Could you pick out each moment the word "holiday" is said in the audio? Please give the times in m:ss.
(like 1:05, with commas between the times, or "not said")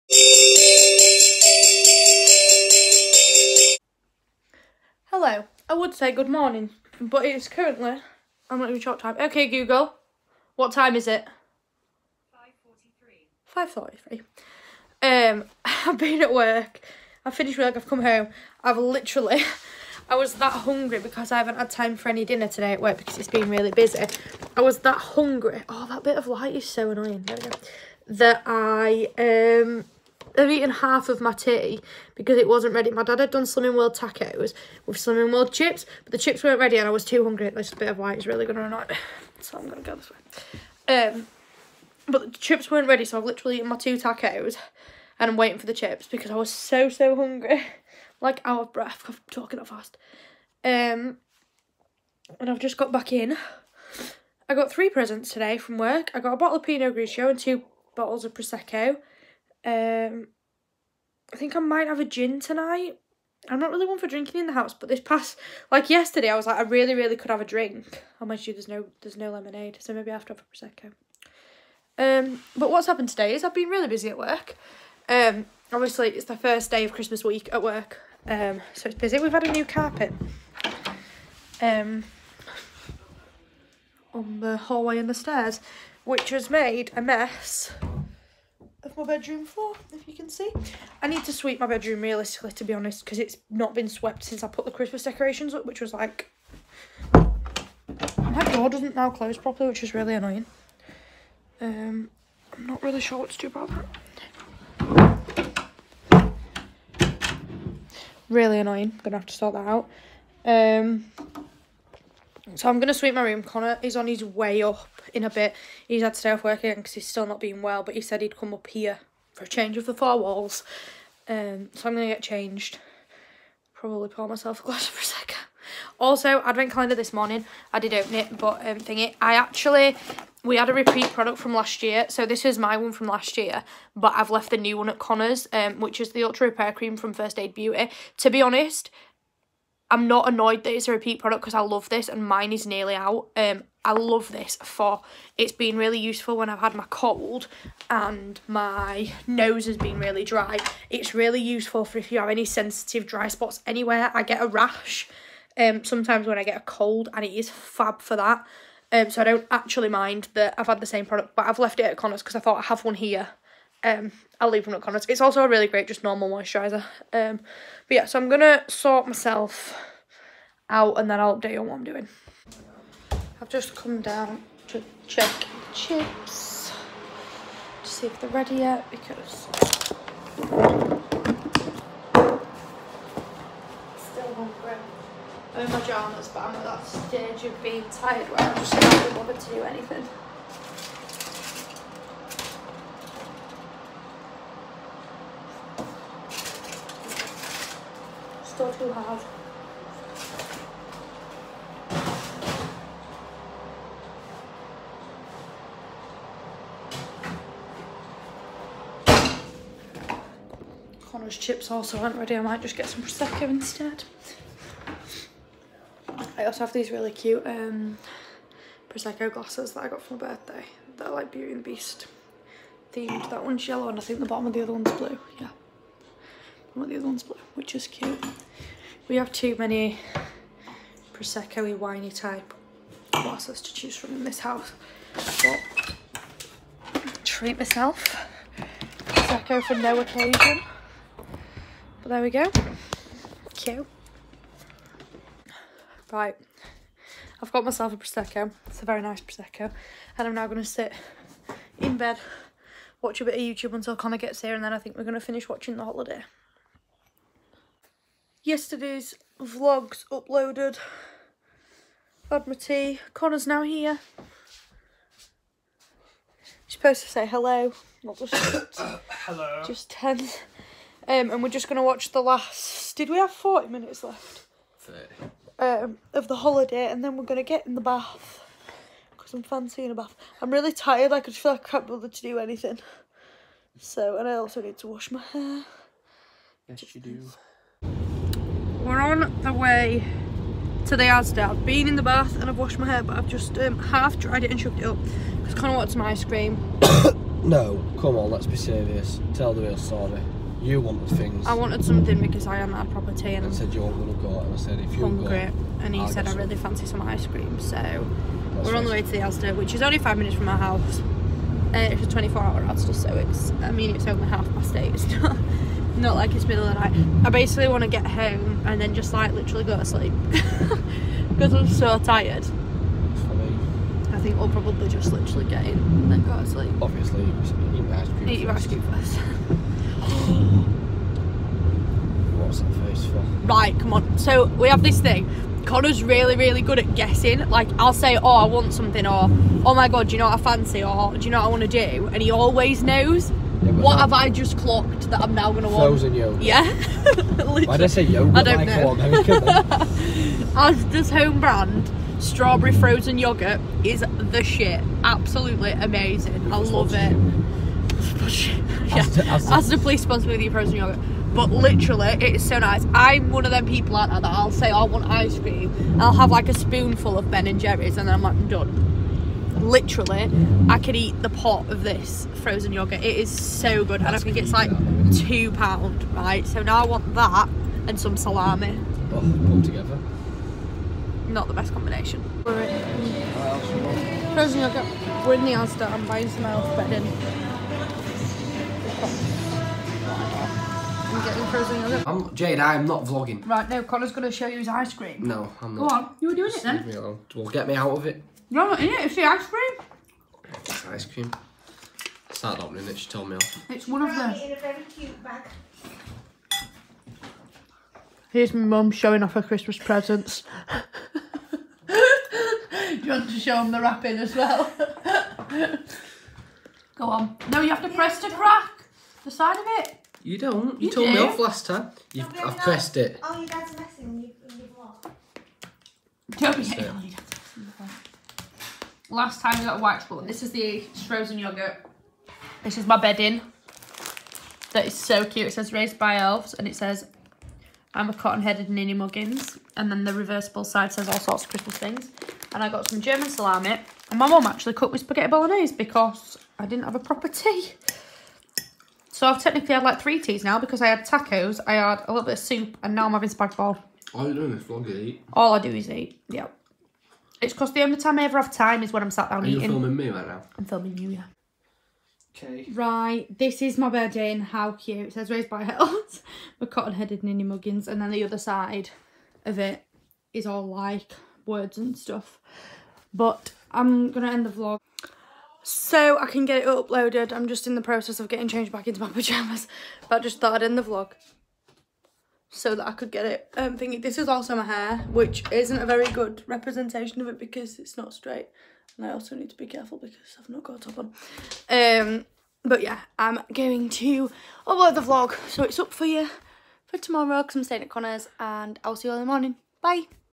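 4:15, 4:36.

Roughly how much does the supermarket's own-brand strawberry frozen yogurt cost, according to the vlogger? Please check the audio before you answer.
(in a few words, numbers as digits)
£2.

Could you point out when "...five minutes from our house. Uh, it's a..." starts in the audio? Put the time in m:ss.
5:09.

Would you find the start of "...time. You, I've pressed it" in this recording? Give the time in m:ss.
7:01.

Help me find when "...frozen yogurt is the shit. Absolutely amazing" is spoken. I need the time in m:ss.
5:52.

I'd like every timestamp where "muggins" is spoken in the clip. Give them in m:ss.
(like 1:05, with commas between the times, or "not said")
7:18, 7:47.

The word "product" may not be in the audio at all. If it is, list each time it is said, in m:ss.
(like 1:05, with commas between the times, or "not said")
2:11, 2:21, 2:41.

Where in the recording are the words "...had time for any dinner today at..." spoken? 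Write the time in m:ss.
0:21.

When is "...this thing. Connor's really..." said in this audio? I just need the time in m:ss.
5:34.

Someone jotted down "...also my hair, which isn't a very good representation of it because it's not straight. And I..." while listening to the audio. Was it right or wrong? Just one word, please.
right.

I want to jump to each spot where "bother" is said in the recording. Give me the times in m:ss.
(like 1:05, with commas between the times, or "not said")
3:09, 4:41.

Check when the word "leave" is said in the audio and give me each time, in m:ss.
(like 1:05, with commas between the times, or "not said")
2:44, 6:36.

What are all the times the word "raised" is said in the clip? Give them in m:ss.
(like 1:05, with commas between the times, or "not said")
7:15, 7:45.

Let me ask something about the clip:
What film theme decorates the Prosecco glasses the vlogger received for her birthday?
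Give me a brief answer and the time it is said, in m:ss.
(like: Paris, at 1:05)
Beauty and the Beast, at 3:41.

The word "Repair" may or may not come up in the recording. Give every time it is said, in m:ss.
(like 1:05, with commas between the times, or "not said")
2:16.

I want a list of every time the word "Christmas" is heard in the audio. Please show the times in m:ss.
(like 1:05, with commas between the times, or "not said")
1:16, 1:34, 6:49, 7:21.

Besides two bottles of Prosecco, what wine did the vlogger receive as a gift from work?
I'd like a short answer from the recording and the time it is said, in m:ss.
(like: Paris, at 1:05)
Pinot Grigio, at 0:56.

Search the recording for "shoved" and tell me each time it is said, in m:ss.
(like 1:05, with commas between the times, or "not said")
4:54.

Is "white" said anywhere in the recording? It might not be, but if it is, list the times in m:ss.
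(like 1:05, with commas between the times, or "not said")
0:37, 7:09.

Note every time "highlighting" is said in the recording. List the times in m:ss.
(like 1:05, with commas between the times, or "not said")
not said.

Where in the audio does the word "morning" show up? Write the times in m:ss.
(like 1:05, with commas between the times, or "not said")
0:06, 2:07, 8:19.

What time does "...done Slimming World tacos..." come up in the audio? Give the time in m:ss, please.
0:33.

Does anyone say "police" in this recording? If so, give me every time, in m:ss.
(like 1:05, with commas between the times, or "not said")
5:59.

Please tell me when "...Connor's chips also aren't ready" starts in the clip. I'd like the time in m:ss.
3:31.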